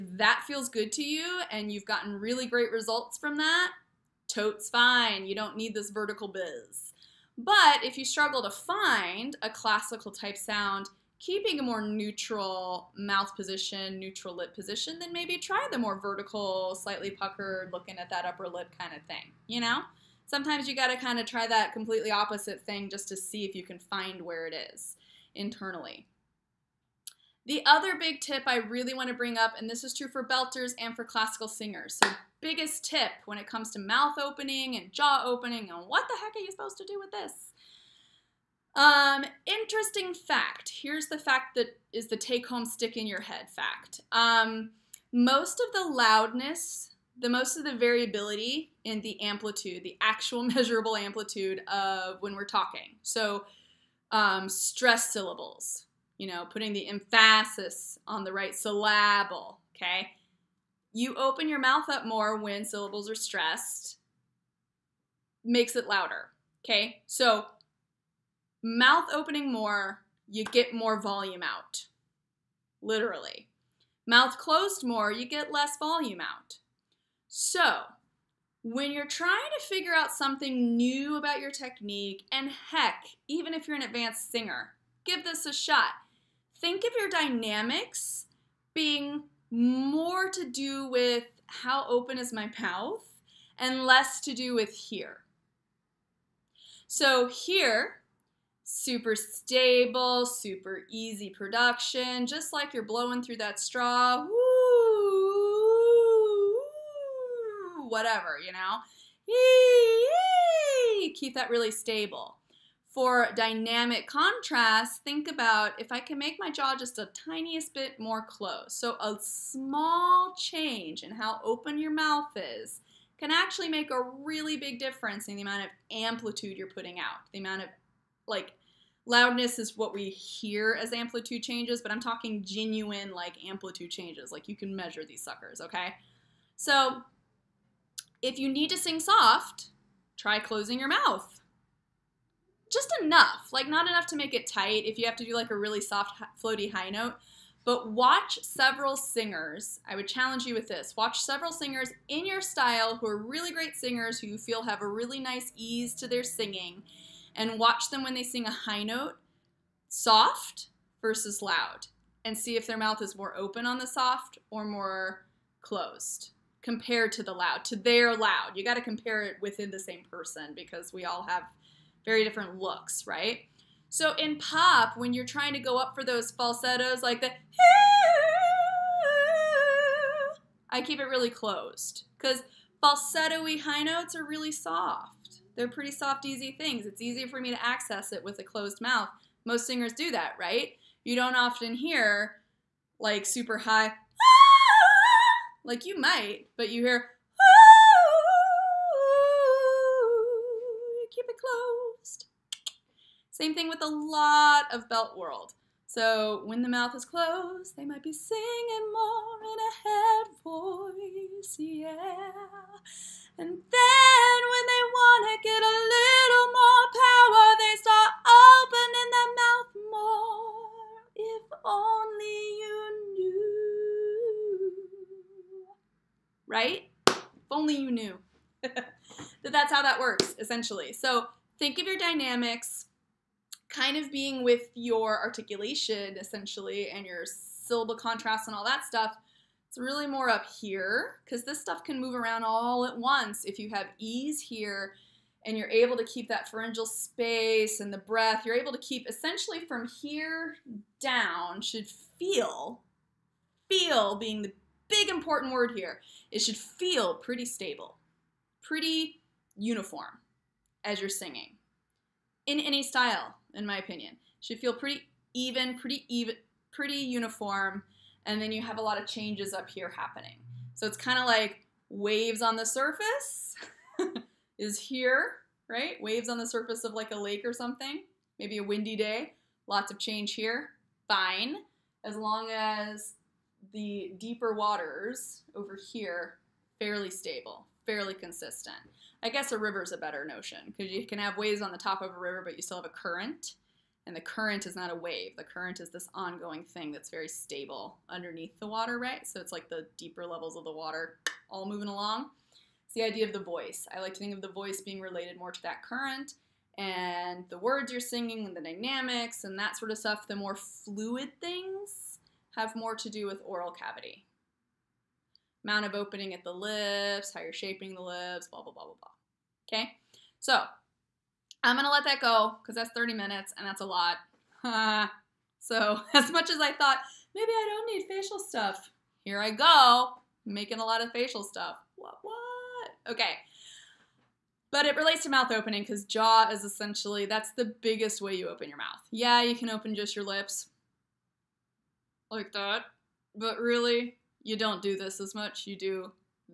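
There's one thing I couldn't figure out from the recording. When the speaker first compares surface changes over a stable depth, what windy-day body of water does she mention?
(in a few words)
lake.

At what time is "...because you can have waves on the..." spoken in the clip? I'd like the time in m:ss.
4:50.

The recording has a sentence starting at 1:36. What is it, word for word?
So here, super stable, super easy production, just like you're blowing through that straw.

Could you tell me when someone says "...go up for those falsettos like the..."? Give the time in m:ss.
2:55.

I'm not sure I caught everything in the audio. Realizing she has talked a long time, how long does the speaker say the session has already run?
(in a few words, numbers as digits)
30 minutes.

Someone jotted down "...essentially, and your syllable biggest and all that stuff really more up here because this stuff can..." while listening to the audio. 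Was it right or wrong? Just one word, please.
wrong.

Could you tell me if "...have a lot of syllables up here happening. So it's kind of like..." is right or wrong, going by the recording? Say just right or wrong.
wrong.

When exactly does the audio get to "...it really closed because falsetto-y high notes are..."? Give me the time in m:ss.
3:00.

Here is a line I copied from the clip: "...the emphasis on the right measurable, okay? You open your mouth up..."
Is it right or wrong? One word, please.
wrong.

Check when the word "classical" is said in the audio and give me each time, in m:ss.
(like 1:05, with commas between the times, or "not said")
0:09, 0:31.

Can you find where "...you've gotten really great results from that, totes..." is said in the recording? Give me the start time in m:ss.
0:01.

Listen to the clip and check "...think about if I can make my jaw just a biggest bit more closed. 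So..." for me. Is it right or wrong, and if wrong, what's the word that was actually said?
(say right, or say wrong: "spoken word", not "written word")
wrong: "tiniest", not "biggest".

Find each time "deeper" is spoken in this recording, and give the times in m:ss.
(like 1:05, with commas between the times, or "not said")
4:44, 4:59.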